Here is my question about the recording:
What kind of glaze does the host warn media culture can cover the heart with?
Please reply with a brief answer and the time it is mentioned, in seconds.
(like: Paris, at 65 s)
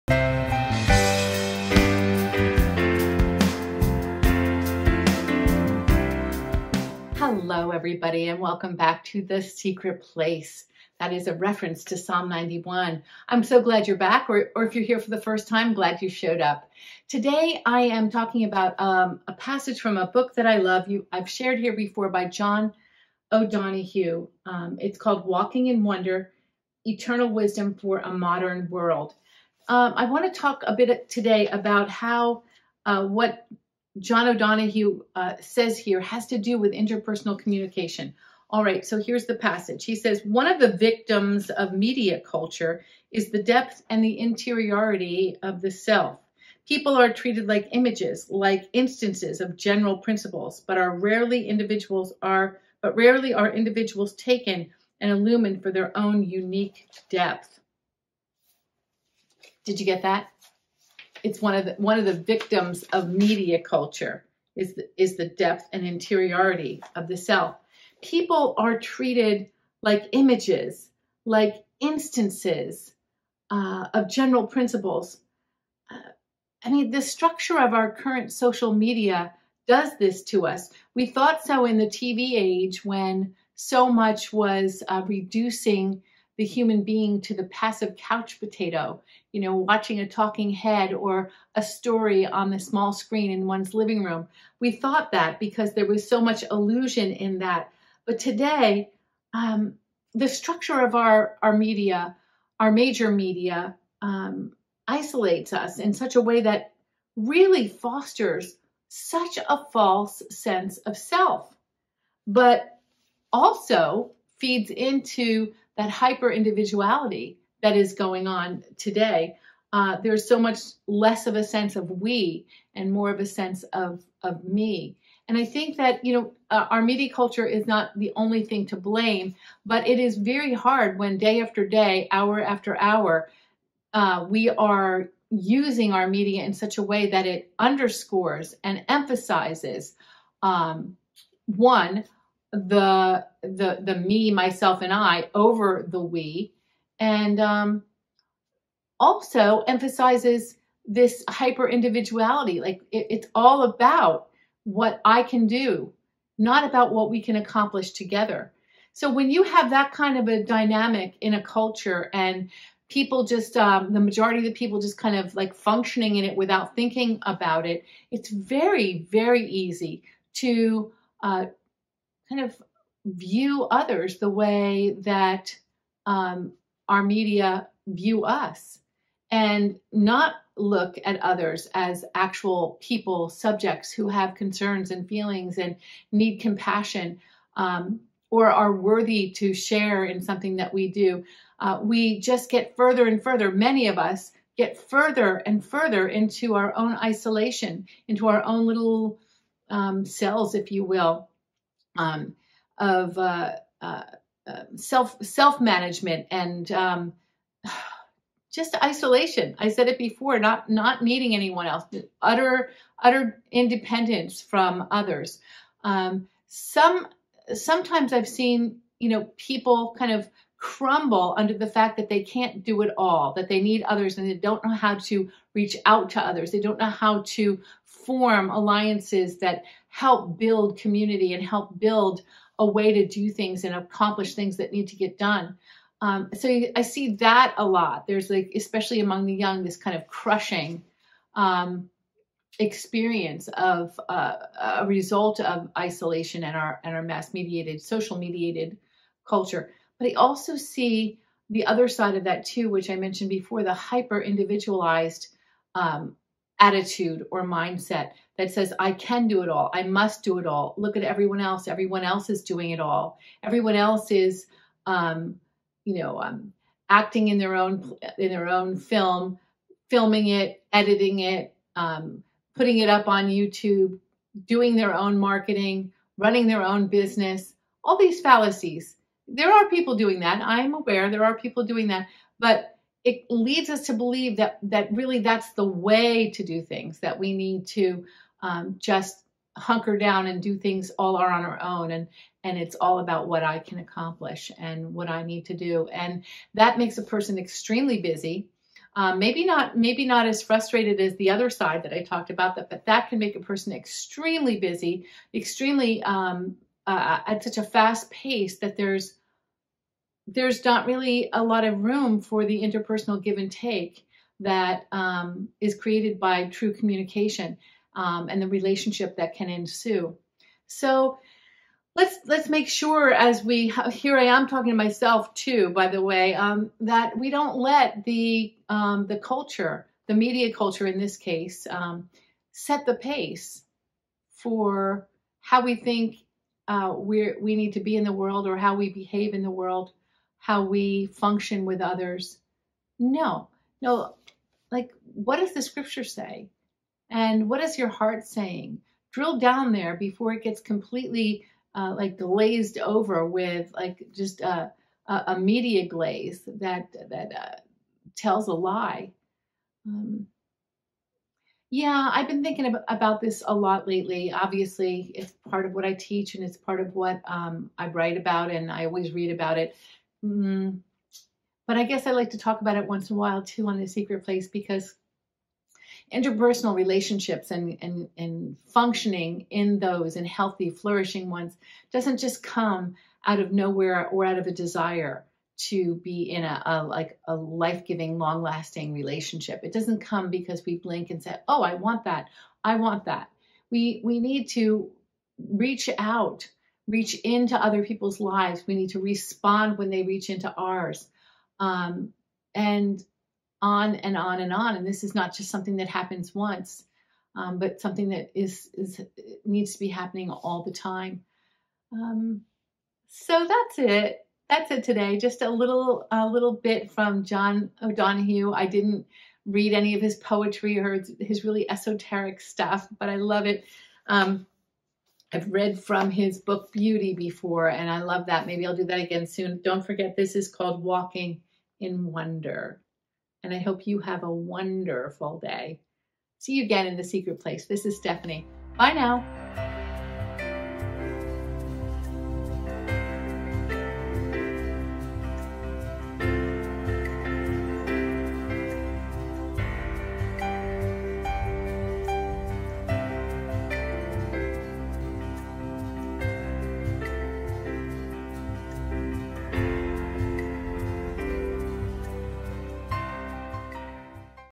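media glaze, at 355 s.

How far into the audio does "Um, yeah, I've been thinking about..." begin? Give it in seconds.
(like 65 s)
359 s.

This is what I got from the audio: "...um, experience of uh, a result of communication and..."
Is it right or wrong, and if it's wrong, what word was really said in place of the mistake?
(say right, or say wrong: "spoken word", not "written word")
wrong: "isolation", not "communication".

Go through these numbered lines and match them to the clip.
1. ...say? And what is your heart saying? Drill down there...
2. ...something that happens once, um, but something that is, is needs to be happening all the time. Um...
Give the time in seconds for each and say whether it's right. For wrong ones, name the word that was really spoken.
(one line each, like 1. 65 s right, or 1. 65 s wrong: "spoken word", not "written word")
1. 346 s right
2. 405 s right.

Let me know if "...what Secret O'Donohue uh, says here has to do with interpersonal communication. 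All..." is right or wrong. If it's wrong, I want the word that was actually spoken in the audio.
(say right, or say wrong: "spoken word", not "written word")
wrong: "John", not "Secret".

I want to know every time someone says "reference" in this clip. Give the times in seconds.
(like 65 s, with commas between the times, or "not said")
11 s.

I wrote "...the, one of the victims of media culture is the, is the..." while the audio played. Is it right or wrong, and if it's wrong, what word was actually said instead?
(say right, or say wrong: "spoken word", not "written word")
right.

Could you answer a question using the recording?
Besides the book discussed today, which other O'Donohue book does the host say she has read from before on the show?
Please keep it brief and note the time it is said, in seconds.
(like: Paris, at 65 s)
Beauty, at 426 s.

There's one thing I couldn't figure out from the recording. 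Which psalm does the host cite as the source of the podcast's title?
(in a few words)
Psalm 91.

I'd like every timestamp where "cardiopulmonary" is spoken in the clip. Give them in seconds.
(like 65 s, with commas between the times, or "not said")
not said.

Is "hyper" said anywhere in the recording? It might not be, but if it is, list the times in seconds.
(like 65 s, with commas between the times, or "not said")
115 s, 151 s, 253 s.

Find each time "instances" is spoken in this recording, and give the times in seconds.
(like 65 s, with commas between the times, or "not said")
48 s, 71 s.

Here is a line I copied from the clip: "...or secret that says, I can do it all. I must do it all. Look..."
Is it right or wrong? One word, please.
wrong.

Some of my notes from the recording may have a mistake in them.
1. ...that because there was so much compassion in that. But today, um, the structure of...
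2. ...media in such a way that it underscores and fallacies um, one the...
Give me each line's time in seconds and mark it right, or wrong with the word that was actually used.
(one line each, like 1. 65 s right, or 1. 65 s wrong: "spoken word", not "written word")
1. 95 s wrong: "illusion", not "compassion"
2. 136 s wrong: "emphasizes", not "fallacies".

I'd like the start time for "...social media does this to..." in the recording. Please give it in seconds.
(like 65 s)
78 s.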